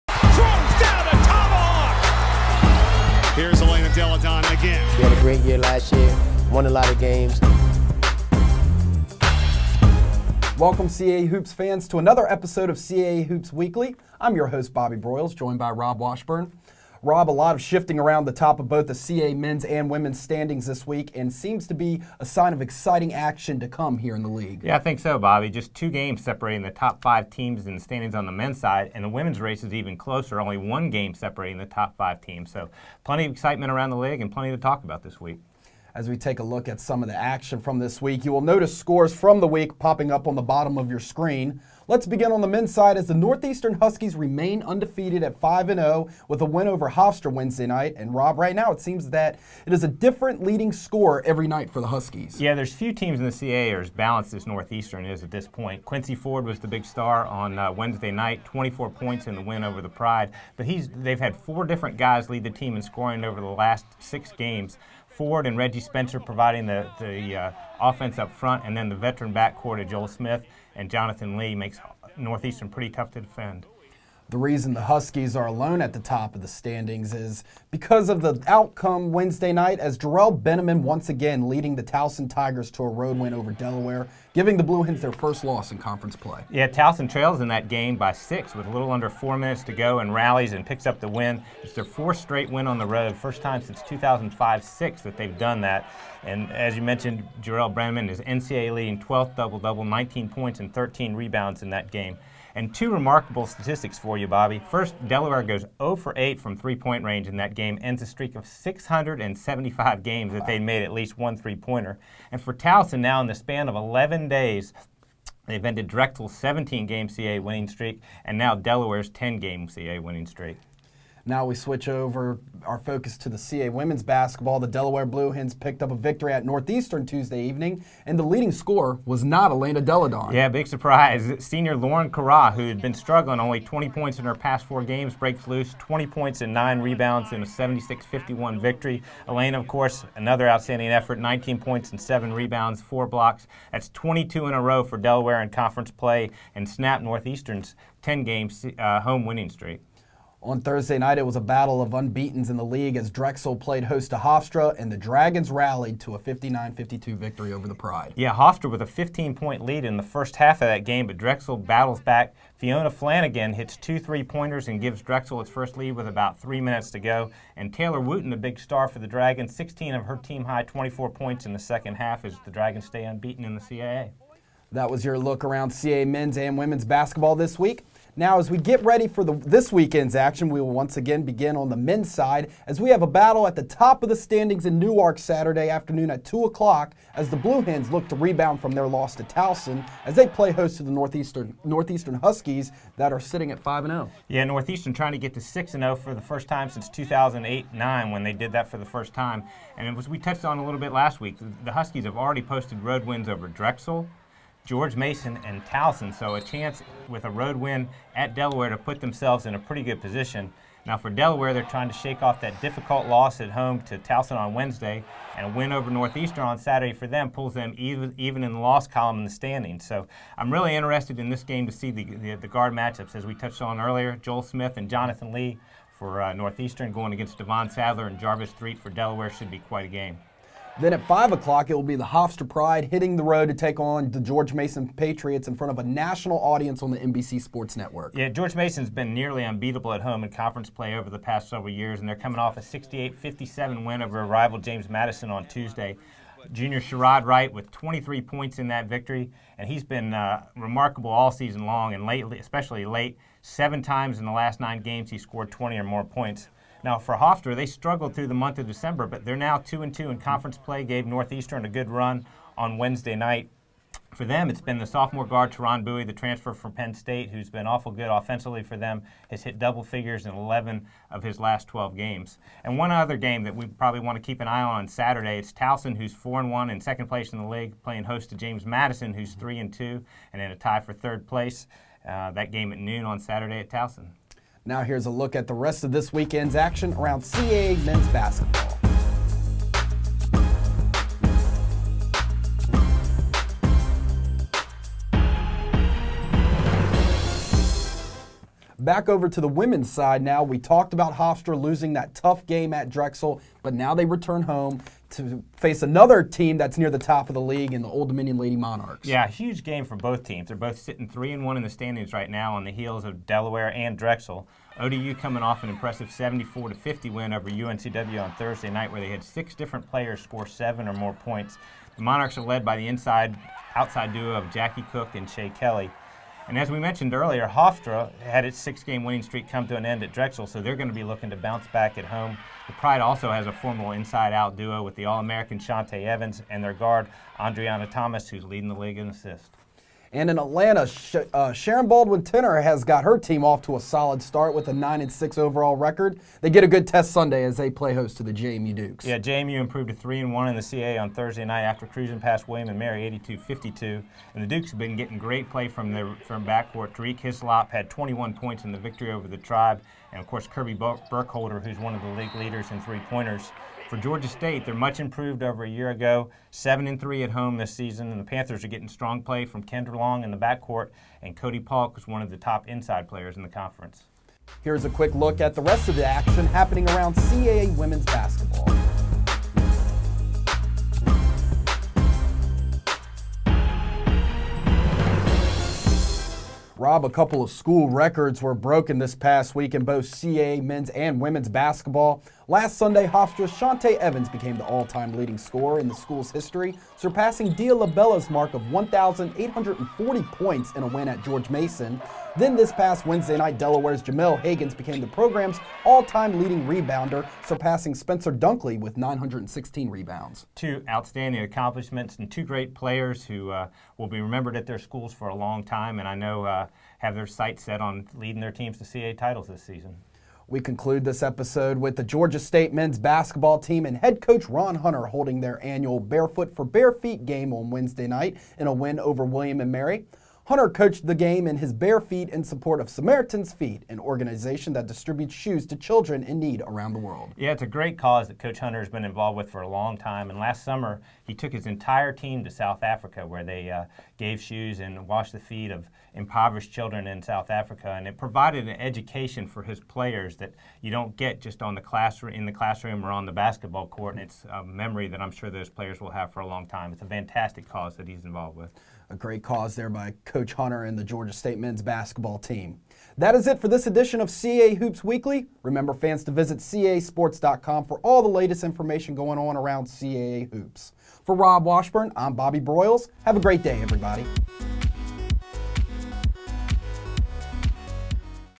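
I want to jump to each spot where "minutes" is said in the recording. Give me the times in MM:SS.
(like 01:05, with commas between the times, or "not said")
01:29, 02:46.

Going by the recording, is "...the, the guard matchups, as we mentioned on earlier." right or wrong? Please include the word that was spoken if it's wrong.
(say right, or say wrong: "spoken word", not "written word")
wrong: "touched", not "mentioned".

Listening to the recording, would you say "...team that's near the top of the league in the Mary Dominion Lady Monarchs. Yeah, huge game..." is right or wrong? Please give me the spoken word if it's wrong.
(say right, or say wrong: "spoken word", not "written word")
wrong: "Old", not "Mary".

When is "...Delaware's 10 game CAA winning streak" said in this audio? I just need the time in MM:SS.
01:58.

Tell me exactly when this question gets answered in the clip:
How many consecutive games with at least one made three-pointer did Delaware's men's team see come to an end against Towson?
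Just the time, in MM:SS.
01:48.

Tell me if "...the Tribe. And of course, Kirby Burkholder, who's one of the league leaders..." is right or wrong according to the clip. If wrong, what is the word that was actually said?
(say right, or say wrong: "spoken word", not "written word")
right.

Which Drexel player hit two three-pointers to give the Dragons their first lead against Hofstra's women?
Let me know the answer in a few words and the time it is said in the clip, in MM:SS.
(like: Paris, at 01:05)
Fiona Flanagan, at 02:42.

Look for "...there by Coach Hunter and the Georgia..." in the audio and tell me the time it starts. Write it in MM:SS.
07:39.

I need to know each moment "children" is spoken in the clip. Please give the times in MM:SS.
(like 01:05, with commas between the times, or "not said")
07:15, 07:26.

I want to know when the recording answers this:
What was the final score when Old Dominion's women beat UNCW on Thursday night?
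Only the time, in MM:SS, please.
05:16.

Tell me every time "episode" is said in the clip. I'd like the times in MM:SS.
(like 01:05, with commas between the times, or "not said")
00:12, 07:01.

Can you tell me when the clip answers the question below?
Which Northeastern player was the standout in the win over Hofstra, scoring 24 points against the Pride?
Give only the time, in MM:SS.
00:55.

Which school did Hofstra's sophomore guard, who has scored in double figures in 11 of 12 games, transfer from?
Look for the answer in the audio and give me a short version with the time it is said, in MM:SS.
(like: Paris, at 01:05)
Penn State, at 04:26.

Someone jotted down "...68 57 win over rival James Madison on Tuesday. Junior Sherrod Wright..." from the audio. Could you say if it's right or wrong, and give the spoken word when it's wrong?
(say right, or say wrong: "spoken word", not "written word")
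right.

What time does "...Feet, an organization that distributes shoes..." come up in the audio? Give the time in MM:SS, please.
07:13.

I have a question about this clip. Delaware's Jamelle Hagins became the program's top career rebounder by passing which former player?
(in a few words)
Spencer Dunkley.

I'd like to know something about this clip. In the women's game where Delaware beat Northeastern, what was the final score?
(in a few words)
76-51.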